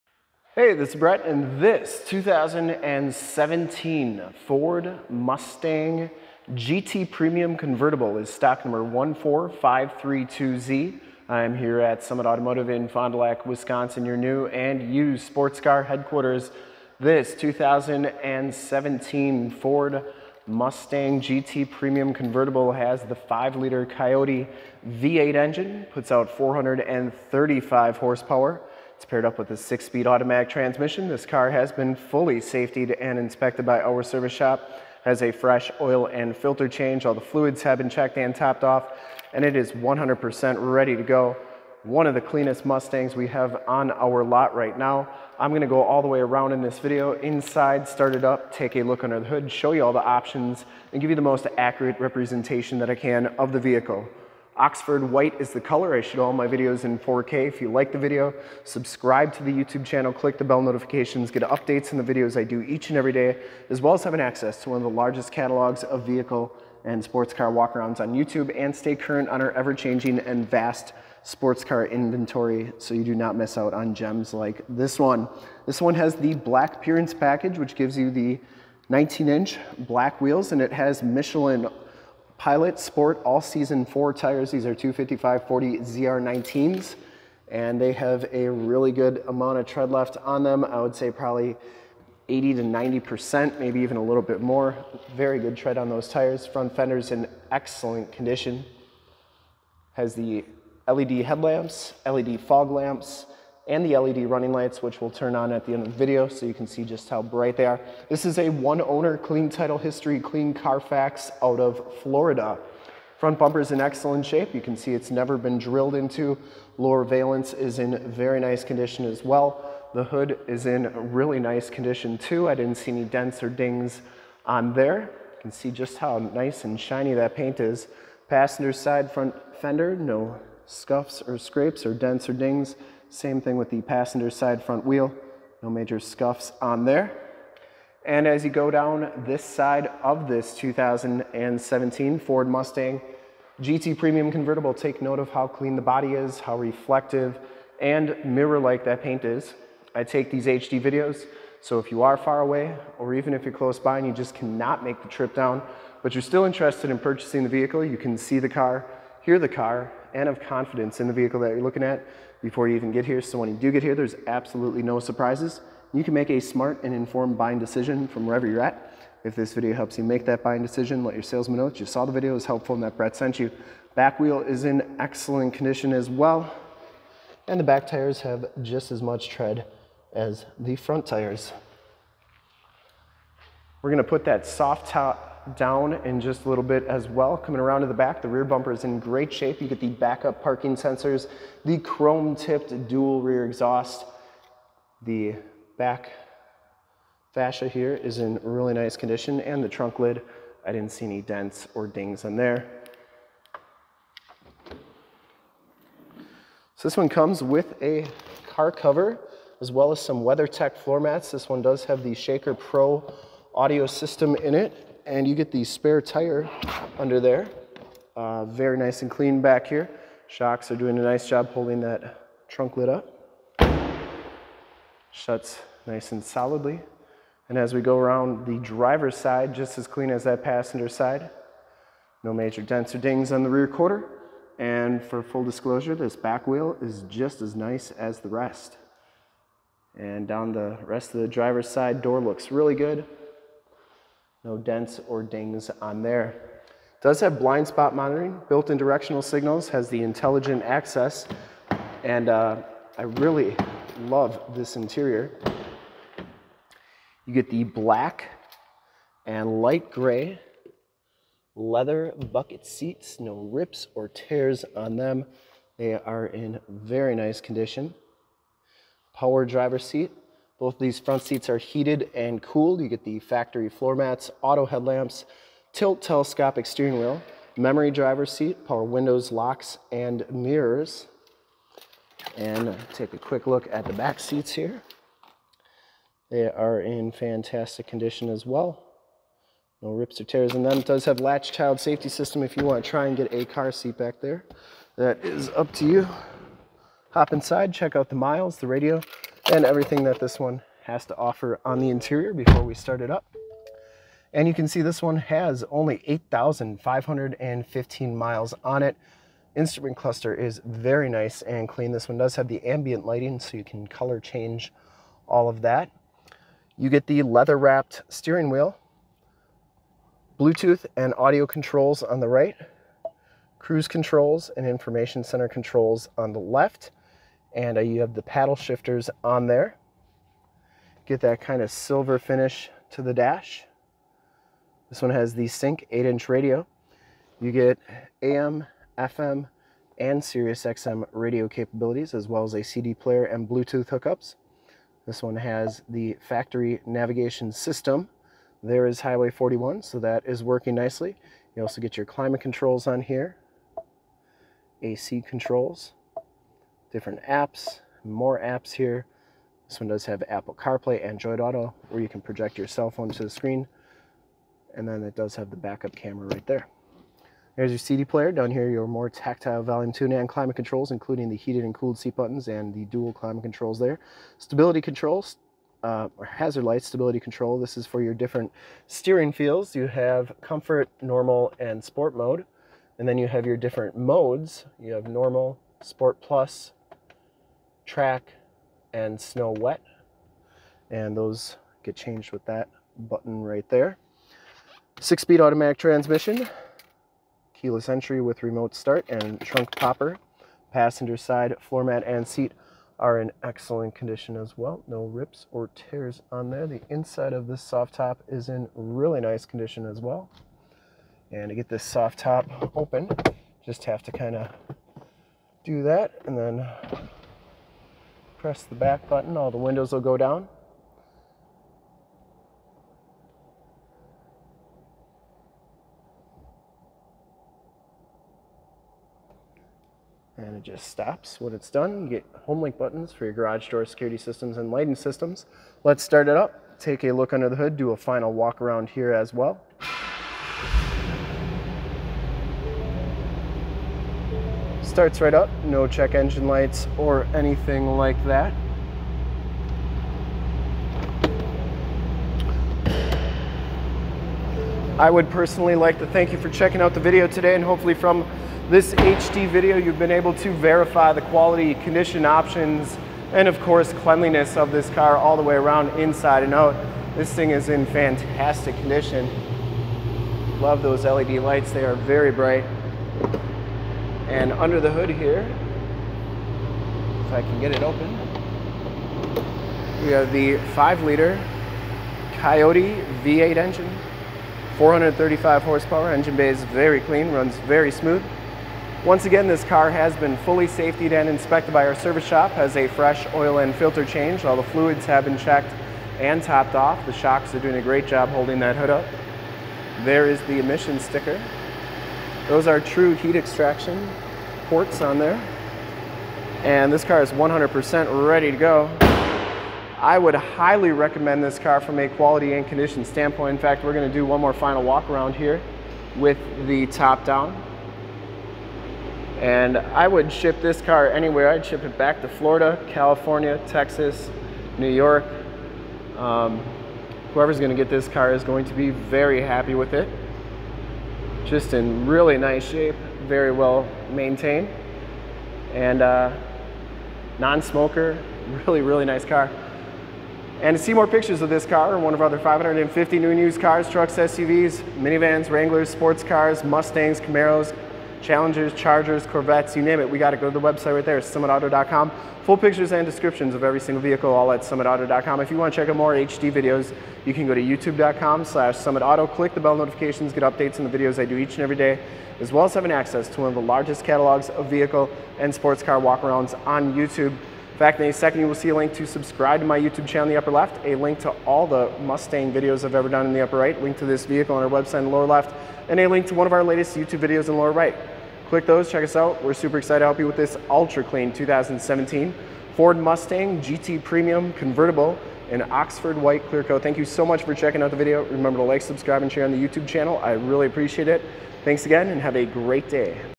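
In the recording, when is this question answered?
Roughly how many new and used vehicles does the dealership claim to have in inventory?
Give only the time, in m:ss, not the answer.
9:02.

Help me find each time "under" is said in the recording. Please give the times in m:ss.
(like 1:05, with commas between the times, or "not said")
0:49, 3:36, 7:17, 7:54.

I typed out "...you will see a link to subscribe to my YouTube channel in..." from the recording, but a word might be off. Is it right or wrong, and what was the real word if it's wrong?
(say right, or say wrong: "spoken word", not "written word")
right.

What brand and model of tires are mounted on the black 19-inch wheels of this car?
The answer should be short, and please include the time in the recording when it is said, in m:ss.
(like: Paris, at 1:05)
Michelin Pilot Sport All Season 4, at 1:21.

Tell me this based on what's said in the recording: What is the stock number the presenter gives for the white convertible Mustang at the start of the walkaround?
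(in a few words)
14532Z.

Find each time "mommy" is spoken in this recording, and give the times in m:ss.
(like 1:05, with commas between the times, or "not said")
not said.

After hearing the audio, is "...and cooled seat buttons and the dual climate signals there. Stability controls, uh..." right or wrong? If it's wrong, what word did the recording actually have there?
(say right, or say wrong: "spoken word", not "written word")
wrong: "controls", not "signals".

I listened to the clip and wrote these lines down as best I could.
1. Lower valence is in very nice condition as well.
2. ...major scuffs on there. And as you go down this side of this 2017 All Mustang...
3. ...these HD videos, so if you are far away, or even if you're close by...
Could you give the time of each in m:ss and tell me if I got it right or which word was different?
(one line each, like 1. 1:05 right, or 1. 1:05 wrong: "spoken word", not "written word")
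1. 1:56 right
2. 2:15 wrong: "Ford", not "All"
3. 2:30 right.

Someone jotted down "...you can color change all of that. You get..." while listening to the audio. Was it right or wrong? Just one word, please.
right.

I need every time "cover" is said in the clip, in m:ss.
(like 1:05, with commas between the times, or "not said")
3:28.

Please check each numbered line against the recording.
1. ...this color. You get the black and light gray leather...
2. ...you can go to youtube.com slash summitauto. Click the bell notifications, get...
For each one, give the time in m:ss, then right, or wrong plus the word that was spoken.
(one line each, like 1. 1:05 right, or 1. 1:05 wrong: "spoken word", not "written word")
1. 4:14 wrong: "interior", not "color"
2. 9:17 right.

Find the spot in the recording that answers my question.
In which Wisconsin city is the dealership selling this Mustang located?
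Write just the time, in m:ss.
0:12.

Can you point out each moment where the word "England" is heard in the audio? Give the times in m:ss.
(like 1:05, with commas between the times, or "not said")
not said.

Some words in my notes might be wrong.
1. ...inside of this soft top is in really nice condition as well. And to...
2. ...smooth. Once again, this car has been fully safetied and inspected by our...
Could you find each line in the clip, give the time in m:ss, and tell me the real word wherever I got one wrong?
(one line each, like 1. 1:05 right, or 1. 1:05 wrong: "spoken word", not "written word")
1. 6:46 right
2. 8:07 right.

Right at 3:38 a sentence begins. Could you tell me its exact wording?
Uh, very nice and clean back here.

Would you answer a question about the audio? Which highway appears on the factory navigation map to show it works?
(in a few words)
Highway 41.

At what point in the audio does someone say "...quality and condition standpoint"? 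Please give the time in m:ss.
8:32.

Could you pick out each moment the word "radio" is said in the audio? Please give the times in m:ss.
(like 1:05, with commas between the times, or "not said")
4:58, 5:36, 5:41.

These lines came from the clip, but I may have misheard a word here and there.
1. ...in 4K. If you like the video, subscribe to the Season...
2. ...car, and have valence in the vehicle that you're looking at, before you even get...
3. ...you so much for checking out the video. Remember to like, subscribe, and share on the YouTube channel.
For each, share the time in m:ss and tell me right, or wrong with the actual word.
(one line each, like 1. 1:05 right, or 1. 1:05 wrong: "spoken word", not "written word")
1. 0:56 wrong: "YouTube", not "Season"
2. 2:39 wrong: "confidence", not "valence"
3. 9:46 right.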